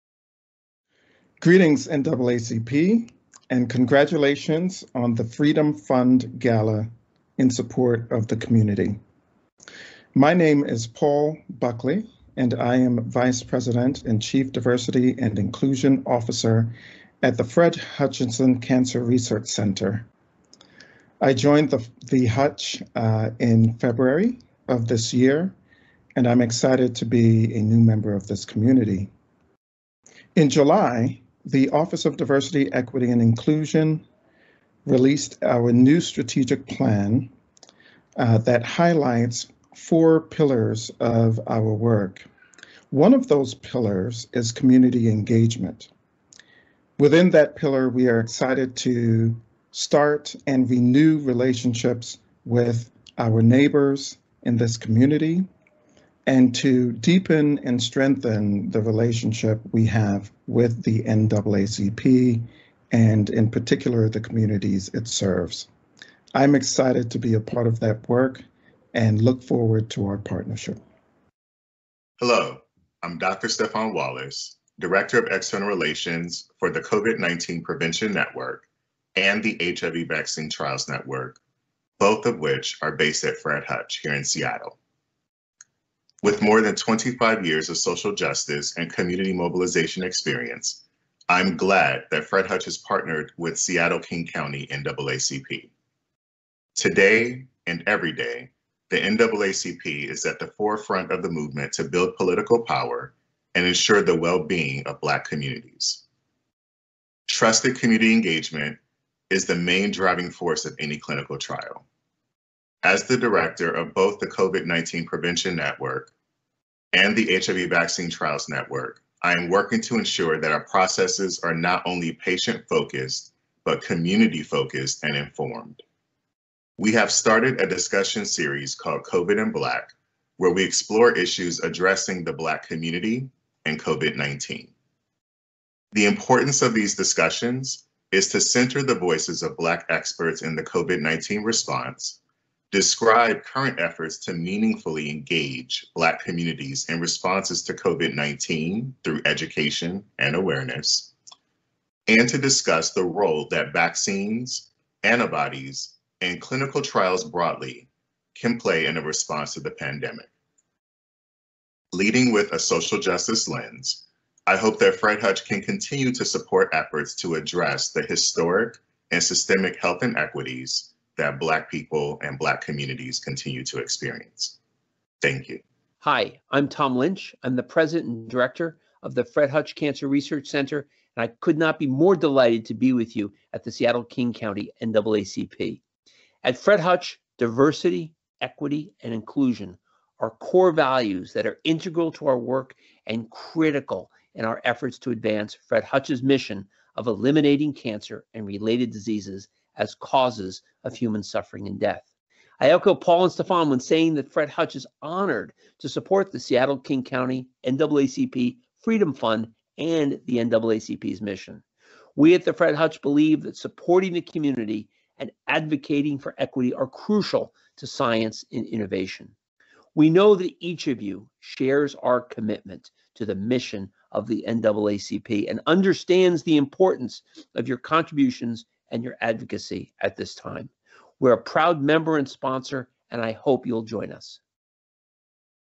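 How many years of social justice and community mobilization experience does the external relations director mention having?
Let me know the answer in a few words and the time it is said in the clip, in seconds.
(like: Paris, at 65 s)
25, at 86 s.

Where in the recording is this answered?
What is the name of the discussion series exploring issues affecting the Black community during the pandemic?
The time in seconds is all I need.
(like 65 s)
129 s.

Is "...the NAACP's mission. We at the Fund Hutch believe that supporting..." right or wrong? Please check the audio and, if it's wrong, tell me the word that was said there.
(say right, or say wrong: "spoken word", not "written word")
wrong: "Fred", not "Fund".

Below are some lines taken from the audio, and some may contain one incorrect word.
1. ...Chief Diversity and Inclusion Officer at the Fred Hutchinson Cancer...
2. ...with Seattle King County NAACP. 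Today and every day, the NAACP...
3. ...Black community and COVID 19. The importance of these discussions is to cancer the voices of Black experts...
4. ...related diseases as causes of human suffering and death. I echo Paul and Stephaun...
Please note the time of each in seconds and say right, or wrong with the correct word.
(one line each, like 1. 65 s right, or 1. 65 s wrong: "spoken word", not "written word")
1. 14 s right
2. 93 s right
3. 132 s wrong: "center", not "cancer"
4. 198 s right.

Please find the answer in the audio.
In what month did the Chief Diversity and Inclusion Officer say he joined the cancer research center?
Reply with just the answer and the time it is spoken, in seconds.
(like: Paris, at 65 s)
February, at 23 s.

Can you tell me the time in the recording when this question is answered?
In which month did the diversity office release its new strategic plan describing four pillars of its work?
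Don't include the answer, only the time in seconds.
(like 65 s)
30 s.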